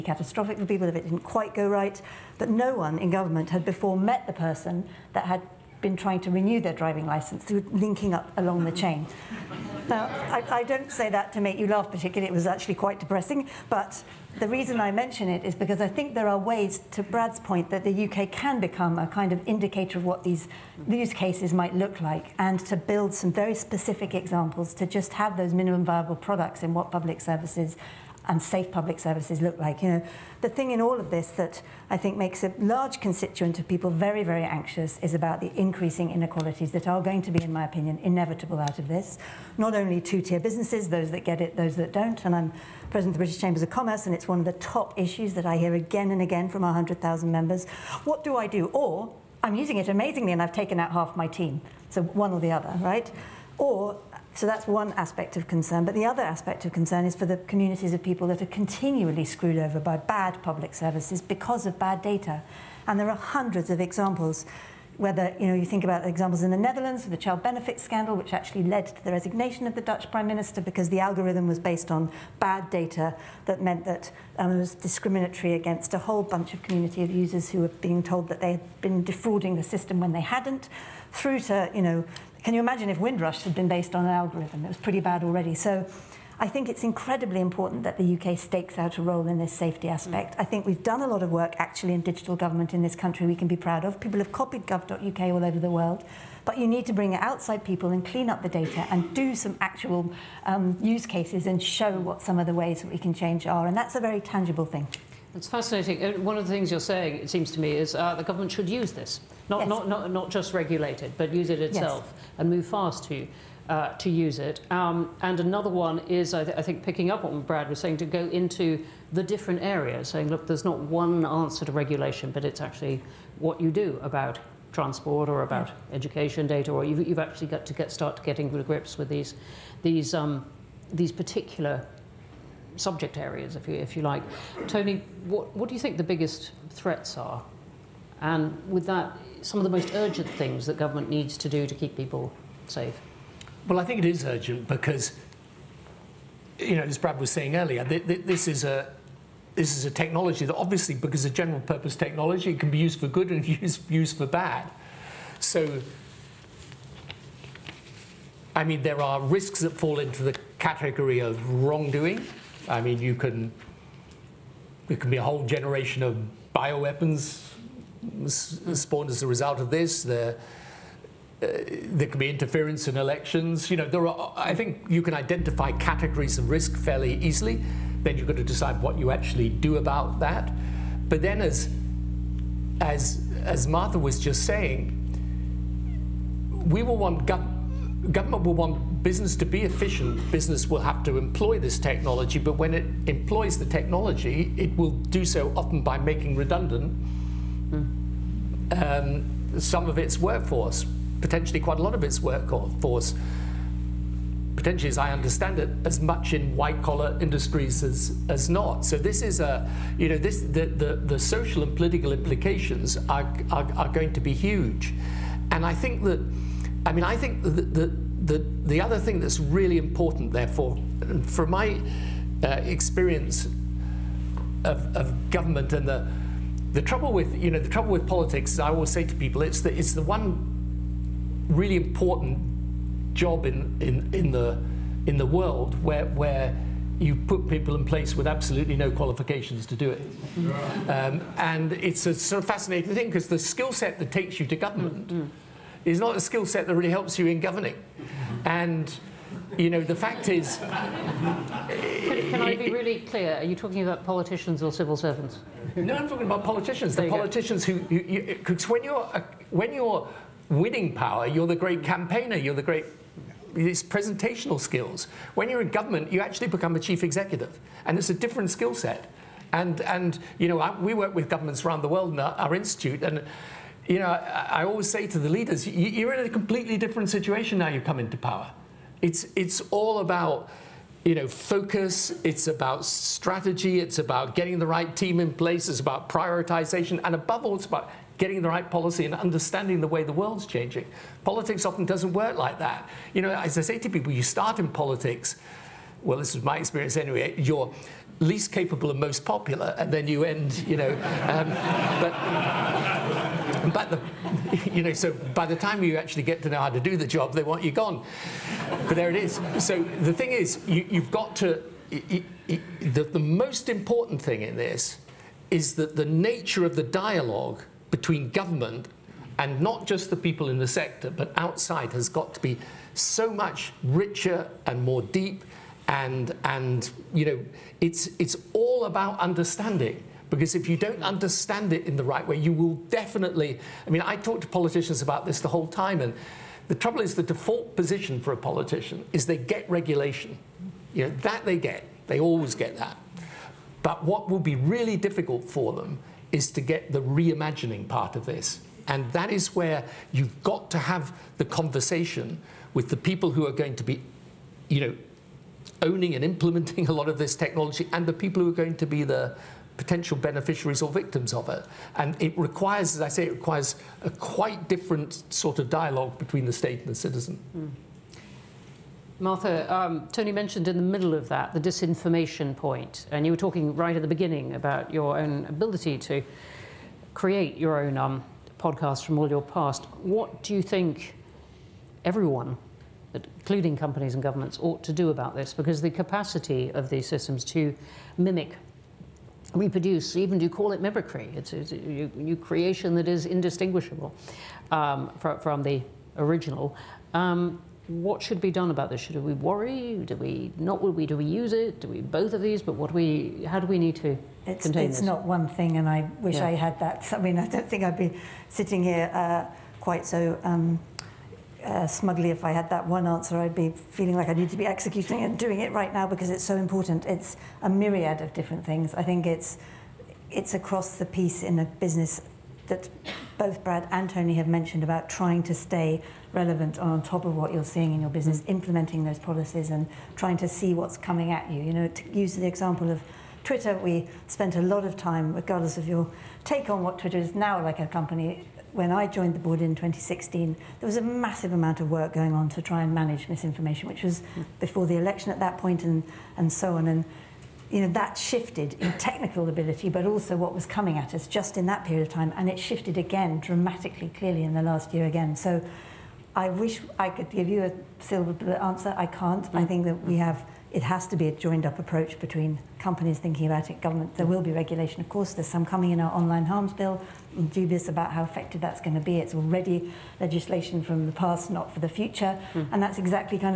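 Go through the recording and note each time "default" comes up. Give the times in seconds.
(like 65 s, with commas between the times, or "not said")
337 s.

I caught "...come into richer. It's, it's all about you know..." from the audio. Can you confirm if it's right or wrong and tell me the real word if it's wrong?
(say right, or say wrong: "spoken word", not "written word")
wrong: "power", not "richer".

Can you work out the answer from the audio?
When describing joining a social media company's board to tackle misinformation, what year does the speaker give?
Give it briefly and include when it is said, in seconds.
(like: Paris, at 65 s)
2016, at 439 s.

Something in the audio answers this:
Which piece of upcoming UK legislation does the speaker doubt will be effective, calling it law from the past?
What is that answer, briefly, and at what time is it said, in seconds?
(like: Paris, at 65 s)
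Online harms bill, at 466 s.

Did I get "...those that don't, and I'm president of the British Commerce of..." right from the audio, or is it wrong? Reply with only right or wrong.
wrong.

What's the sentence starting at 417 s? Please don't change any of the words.
It's a myriad of different things.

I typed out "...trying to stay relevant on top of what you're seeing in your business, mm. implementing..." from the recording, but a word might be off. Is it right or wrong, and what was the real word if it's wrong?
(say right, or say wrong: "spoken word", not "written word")
right.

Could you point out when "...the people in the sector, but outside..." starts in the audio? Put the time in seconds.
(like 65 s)
320 s.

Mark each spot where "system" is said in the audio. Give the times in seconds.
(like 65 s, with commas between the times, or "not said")
79 s, 387 s.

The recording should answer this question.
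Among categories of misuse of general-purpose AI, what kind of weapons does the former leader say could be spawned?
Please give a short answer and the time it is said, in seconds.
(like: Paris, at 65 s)
Bioweapons, at 166 s.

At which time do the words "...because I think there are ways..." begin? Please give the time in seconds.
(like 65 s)
15 s.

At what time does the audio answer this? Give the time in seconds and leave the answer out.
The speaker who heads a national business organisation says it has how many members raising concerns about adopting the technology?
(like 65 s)
46 s.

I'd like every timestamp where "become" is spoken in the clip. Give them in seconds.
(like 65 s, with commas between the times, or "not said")
18 s, 266 s.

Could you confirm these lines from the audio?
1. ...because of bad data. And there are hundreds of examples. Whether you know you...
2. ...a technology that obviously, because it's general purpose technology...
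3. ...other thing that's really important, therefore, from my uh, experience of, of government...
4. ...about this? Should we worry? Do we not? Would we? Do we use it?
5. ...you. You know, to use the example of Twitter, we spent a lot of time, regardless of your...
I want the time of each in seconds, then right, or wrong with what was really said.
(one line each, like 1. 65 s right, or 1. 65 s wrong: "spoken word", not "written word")
1. 61 s right
2. 149 s right
3. 218 s right
4. 398 s right
5. 431 s right.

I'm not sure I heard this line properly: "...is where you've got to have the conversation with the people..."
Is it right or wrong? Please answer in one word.
right.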